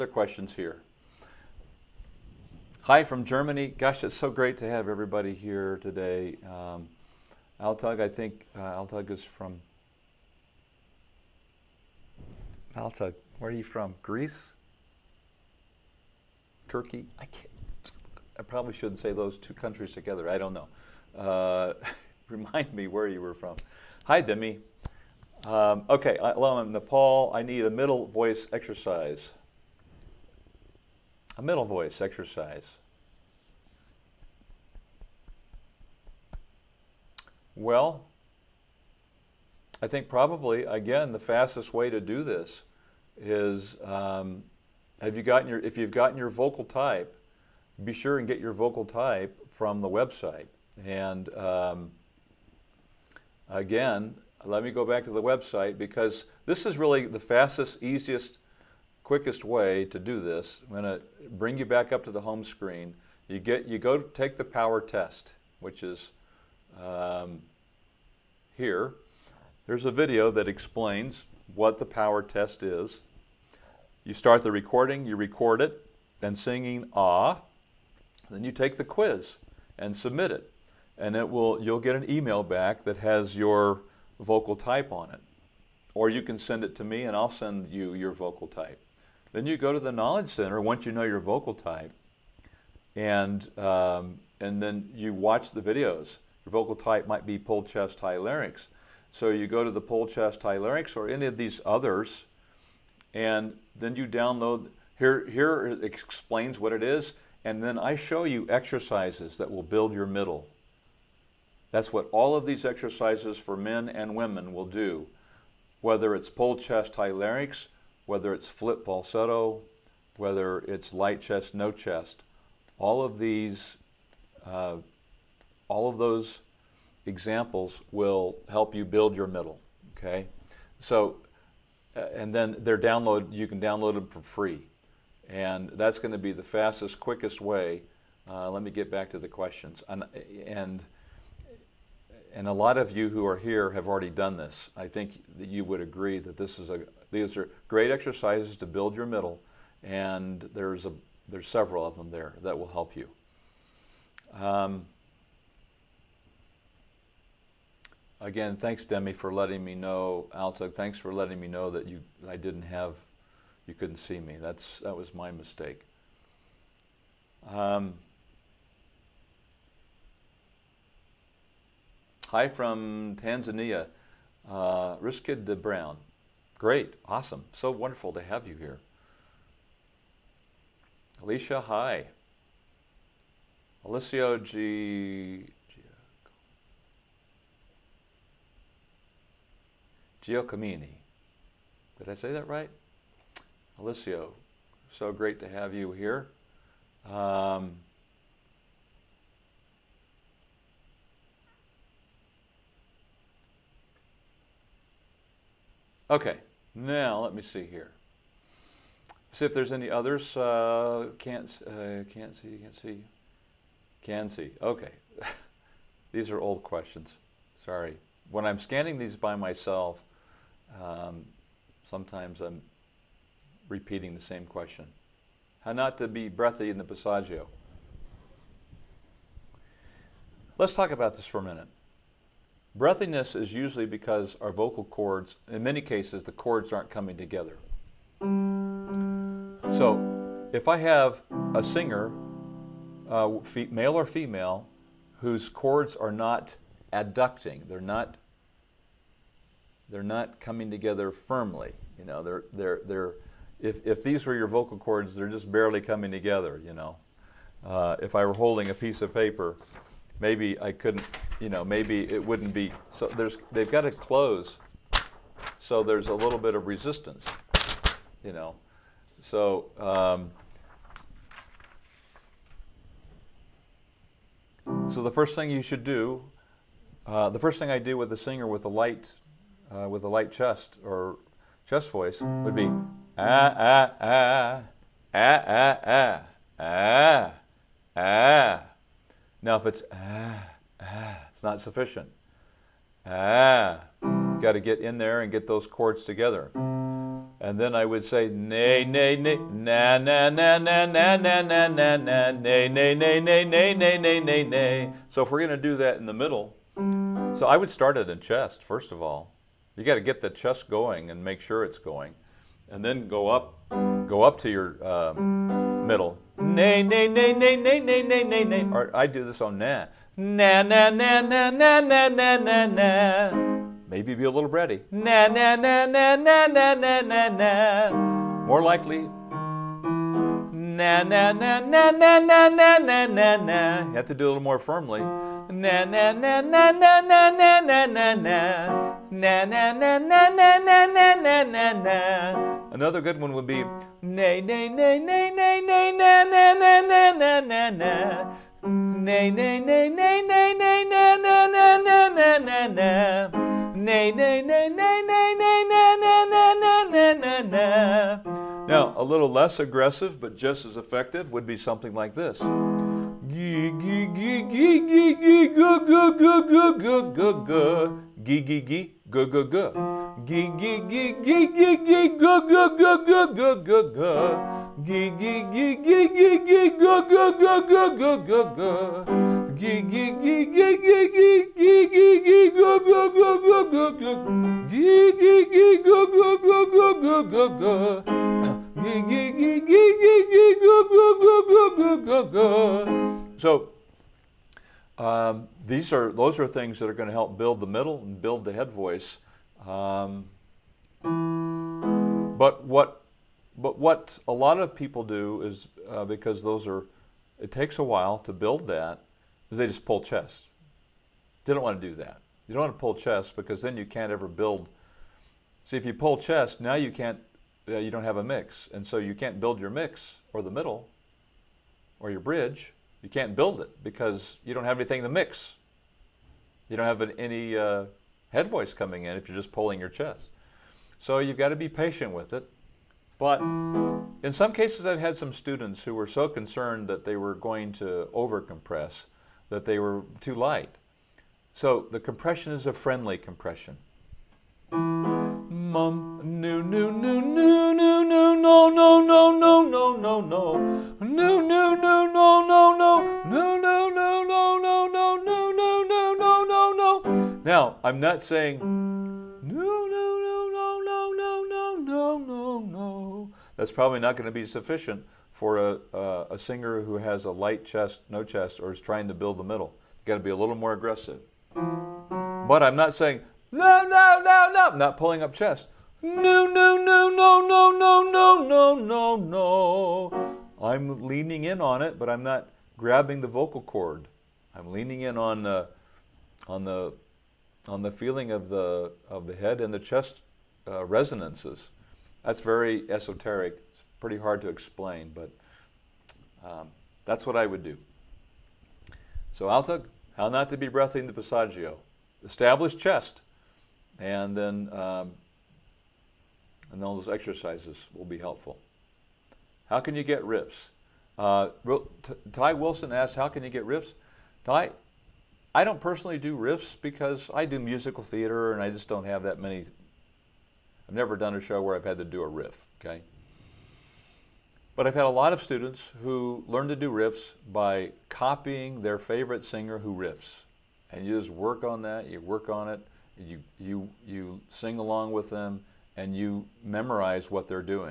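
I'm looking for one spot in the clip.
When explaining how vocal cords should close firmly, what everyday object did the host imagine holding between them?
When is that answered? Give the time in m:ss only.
4:18.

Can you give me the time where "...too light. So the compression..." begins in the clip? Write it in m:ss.
7:20.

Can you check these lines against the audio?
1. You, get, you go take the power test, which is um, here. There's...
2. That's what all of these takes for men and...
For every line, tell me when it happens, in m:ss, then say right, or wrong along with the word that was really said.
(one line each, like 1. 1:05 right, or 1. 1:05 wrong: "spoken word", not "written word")
1. 1:03 right
2. 1:51 wrong: "exercises", not "takes".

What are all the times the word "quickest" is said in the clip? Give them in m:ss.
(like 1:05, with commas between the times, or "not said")
0:59, 2:16.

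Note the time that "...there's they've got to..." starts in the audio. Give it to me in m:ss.
4:23.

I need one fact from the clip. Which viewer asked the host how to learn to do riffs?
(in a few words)
Ty Wilson.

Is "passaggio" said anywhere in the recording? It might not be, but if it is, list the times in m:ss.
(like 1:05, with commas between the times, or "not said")
3:46, 8:21.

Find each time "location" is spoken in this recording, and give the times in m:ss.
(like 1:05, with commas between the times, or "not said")
not said.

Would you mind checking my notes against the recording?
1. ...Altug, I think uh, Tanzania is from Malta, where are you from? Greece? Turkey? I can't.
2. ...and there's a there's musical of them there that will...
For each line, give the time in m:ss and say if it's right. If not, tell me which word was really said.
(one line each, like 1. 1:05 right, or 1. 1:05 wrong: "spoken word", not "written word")
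1. 0:07 wrong: "Altug", not "Tanzania"
2. 2:29 wrong: "several", not "musical".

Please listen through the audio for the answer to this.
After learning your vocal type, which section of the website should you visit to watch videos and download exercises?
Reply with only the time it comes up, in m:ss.
1:29.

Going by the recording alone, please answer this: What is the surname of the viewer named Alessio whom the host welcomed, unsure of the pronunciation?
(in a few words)
Giacomini.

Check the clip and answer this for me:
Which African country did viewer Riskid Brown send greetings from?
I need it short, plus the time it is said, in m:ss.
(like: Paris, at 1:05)
Tanzania, at 2:53.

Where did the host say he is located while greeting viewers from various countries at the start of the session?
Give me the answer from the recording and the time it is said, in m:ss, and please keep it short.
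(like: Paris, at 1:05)
Nepal, at 0:26.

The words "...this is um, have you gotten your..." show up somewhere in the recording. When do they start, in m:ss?
0:42.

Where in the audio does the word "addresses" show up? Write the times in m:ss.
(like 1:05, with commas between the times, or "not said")
not said.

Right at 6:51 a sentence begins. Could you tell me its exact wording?
They don't want to do that.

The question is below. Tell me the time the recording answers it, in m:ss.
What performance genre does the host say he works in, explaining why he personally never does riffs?
8:37.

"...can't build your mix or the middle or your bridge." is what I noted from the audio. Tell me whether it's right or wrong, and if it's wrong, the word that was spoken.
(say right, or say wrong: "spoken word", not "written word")
right.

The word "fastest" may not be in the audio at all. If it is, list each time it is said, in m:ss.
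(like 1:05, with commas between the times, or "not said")
0:41, 0:57, 2:16.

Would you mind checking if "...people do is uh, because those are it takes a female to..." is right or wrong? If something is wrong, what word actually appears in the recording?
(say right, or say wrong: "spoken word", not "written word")
wrong: "while", not "female".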